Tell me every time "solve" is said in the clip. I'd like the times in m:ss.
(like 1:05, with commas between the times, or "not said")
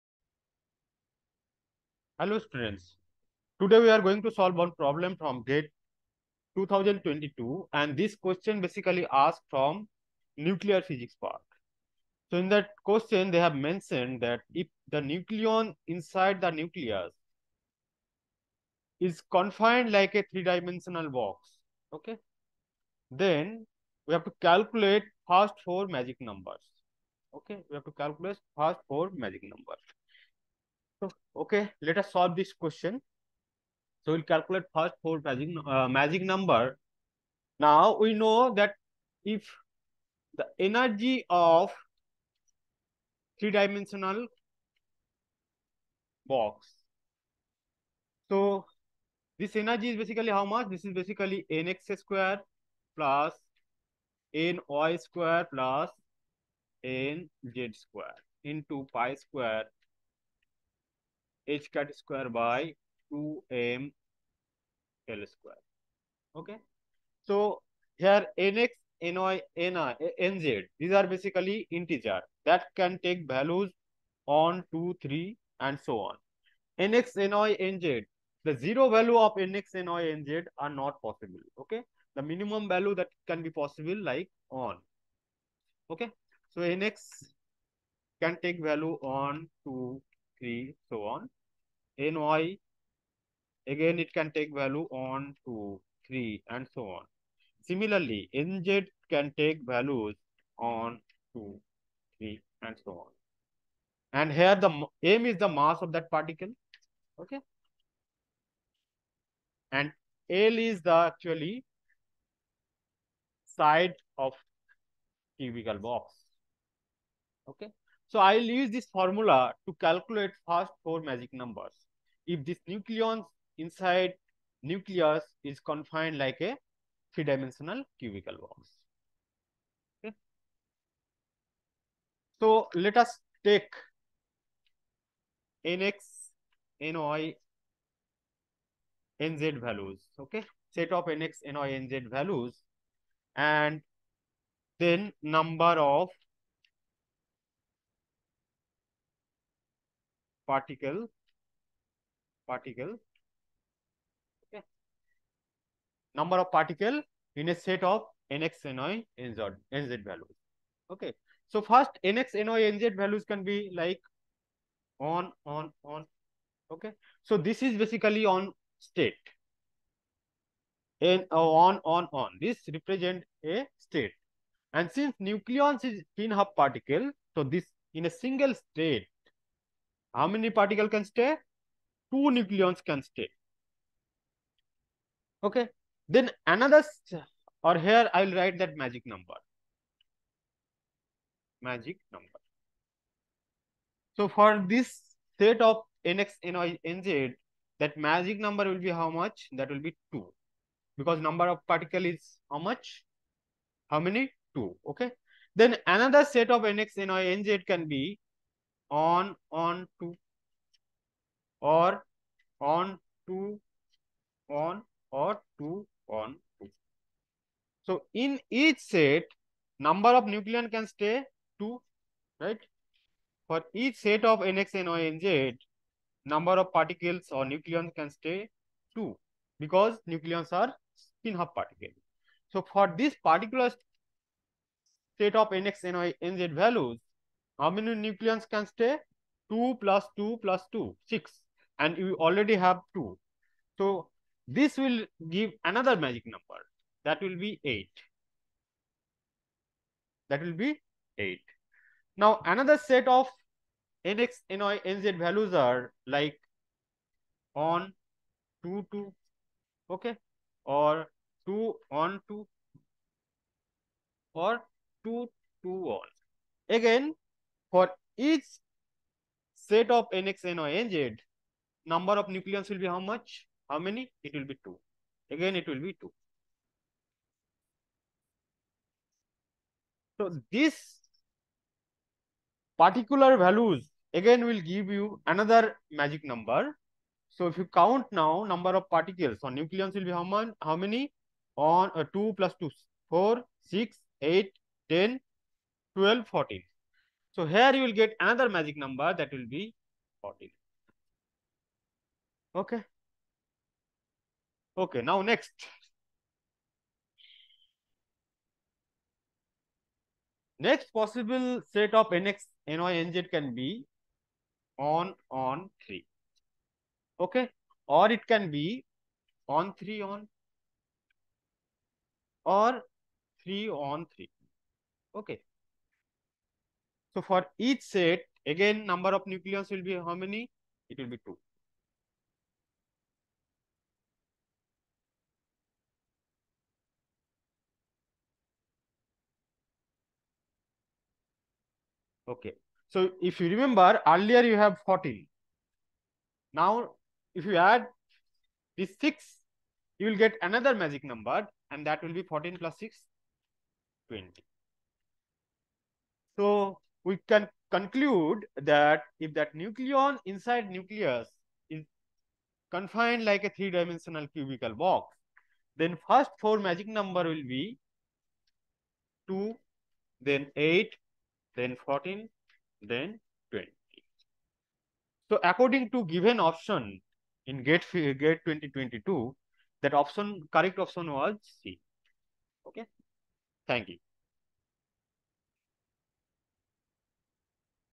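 0:04, 0:32.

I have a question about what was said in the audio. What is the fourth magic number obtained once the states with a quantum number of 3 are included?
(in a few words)
20.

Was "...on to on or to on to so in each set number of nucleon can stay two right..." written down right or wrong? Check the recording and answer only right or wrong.
right.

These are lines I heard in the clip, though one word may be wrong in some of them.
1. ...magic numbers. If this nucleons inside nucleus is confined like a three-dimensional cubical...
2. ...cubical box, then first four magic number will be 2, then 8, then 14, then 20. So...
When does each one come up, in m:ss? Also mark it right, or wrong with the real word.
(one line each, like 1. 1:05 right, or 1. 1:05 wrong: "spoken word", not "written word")
1. 2:01 right
2. 6:04 right.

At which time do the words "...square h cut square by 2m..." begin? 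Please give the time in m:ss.
0:59.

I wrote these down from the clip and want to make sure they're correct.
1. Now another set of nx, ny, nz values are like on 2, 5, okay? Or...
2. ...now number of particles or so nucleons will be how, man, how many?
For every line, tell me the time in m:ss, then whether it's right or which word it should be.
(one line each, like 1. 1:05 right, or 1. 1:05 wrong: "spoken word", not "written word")
1. 4:12 wrong: "2", not "5"
2. 4:48 right.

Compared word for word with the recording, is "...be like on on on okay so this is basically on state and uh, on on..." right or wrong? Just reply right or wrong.
right.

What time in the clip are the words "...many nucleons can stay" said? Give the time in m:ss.
3:57.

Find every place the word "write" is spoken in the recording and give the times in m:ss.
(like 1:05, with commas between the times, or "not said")
3:08.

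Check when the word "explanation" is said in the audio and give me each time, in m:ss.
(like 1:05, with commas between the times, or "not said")
not said.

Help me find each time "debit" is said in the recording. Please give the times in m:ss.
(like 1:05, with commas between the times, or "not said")
not said.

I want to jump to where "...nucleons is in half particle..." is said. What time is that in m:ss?
2:55.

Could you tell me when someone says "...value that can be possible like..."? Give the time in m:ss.
1:22.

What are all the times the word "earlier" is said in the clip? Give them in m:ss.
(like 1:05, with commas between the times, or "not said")
5:44.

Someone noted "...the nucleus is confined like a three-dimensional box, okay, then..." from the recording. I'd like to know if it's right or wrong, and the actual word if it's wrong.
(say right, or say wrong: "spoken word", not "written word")
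right.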